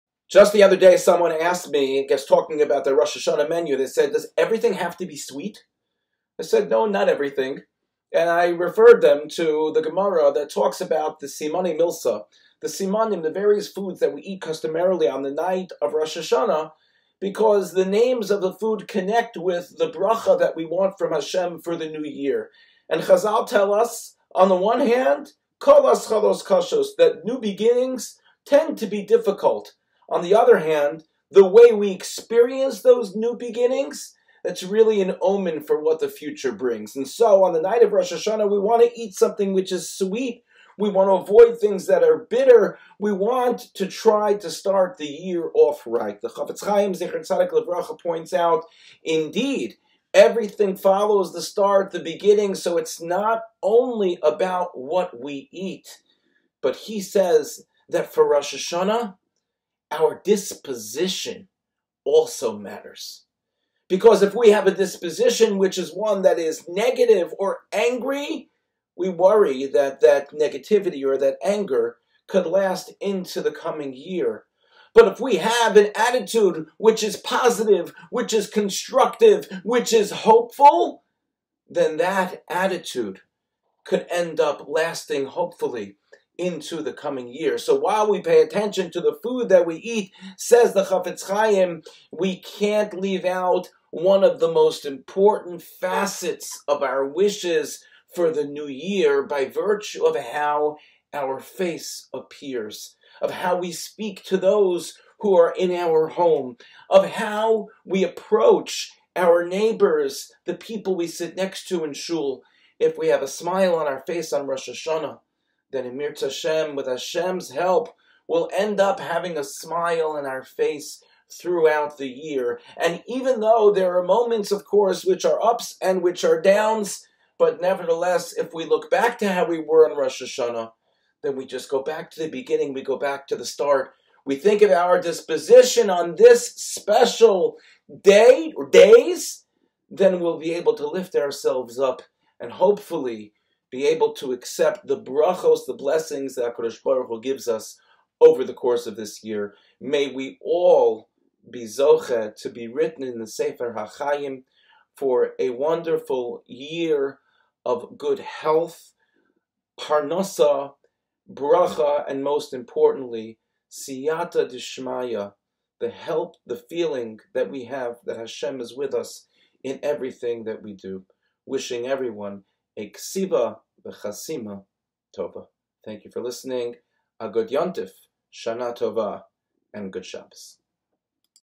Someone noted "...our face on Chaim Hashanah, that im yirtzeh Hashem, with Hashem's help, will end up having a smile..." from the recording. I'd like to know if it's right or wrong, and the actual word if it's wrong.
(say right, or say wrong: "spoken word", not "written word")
wrong: "Rosh", not "Chaim".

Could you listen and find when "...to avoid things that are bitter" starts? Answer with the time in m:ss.
0:41.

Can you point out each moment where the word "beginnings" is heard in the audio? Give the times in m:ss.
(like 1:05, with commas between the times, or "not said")
0:27, 0:33, 0:51, 2:12.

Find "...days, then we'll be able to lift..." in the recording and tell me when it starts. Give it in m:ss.
2:18.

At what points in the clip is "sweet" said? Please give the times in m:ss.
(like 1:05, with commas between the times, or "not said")
0:05, 0:39.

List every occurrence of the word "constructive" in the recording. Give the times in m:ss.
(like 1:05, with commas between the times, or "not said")
1:18.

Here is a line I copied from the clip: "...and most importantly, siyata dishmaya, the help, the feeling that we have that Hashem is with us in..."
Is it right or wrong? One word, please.
right.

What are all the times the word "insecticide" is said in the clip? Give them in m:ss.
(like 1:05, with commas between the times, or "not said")
not said.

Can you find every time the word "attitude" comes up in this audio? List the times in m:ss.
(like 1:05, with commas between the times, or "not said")
1:15, 1:22.